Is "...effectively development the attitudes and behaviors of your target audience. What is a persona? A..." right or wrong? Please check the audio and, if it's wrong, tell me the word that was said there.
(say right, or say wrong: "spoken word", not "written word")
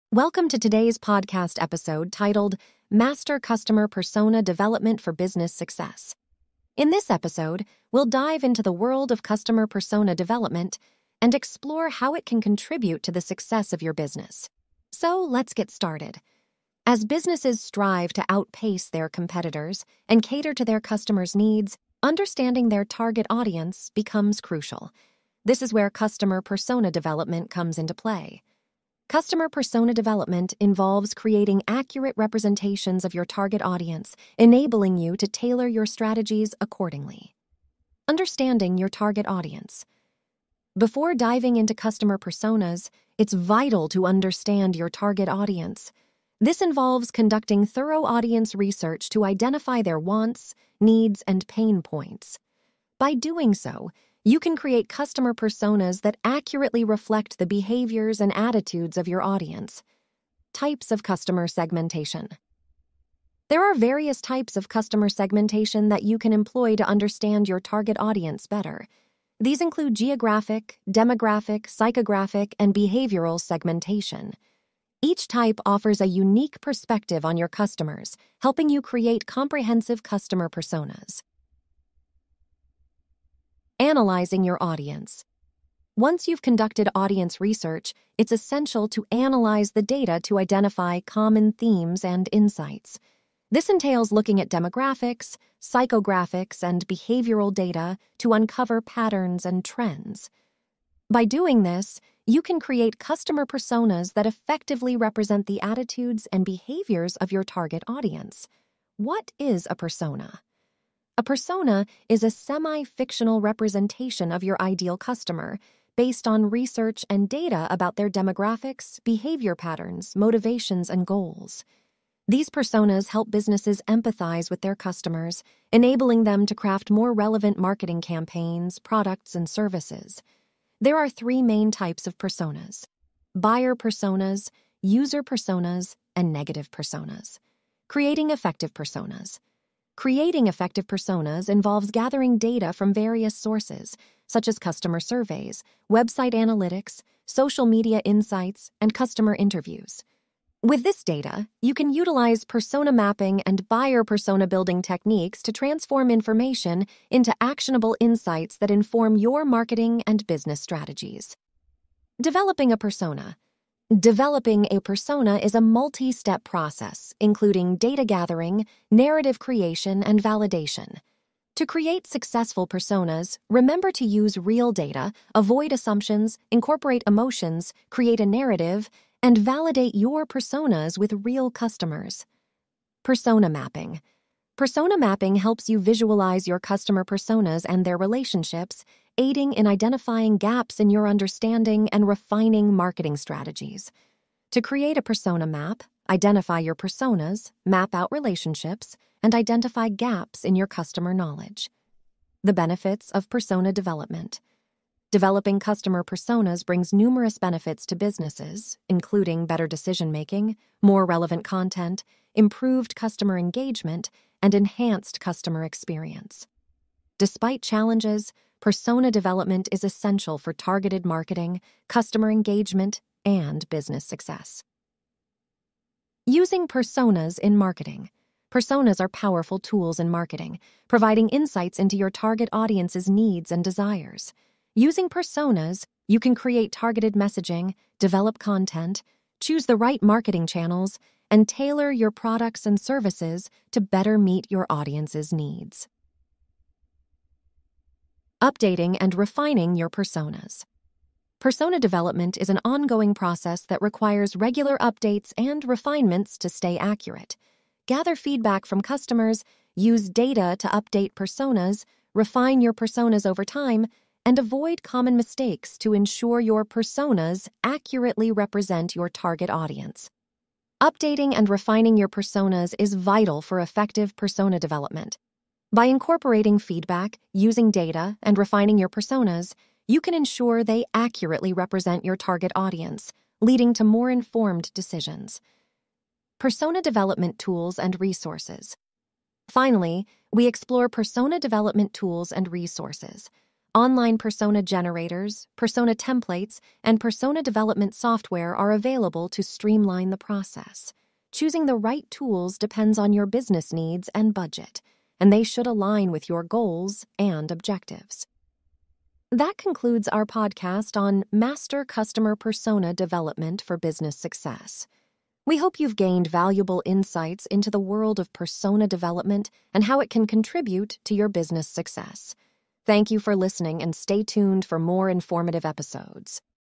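wrong: "represent", not "development".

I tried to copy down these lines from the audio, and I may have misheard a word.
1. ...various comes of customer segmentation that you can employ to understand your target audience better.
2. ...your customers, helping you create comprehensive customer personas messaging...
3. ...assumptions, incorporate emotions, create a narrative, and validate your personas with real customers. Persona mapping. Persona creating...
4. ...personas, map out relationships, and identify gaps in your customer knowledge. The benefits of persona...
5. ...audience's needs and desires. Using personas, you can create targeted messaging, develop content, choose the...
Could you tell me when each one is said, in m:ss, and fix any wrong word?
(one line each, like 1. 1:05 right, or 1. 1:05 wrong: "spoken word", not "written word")
1. 1:03 wrong: "types", not "comes"
2. 1:17 wrong: "analyzing", not "messaging"
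3. 2:55 wrong: "mapping", not "creating"
4. 3:16 right
5. 3:52 right.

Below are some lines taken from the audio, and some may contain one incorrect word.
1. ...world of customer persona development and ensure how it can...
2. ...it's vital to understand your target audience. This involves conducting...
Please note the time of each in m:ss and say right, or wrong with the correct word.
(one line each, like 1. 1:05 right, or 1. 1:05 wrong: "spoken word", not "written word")
1. 0:08 wrong: "explore", not "ensure"
2. 0:43 right.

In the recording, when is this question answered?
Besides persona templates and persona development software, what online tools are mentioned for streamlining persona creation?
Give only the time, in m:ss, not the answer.
4:53.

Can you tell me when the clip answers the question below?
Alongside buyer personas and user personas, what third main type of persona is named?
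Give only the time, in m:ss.
2:16.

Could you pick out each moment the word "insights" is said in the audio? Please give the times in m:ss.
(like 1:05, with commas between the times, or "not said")
1:32, 2:28, 2:37, 3:51, 5:16.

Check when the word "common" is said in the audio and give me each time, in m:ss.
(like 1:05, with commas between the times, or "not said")
1:31, 4:24.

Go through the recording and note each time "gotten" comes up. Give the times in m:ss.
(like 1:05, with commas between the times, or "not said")
not said.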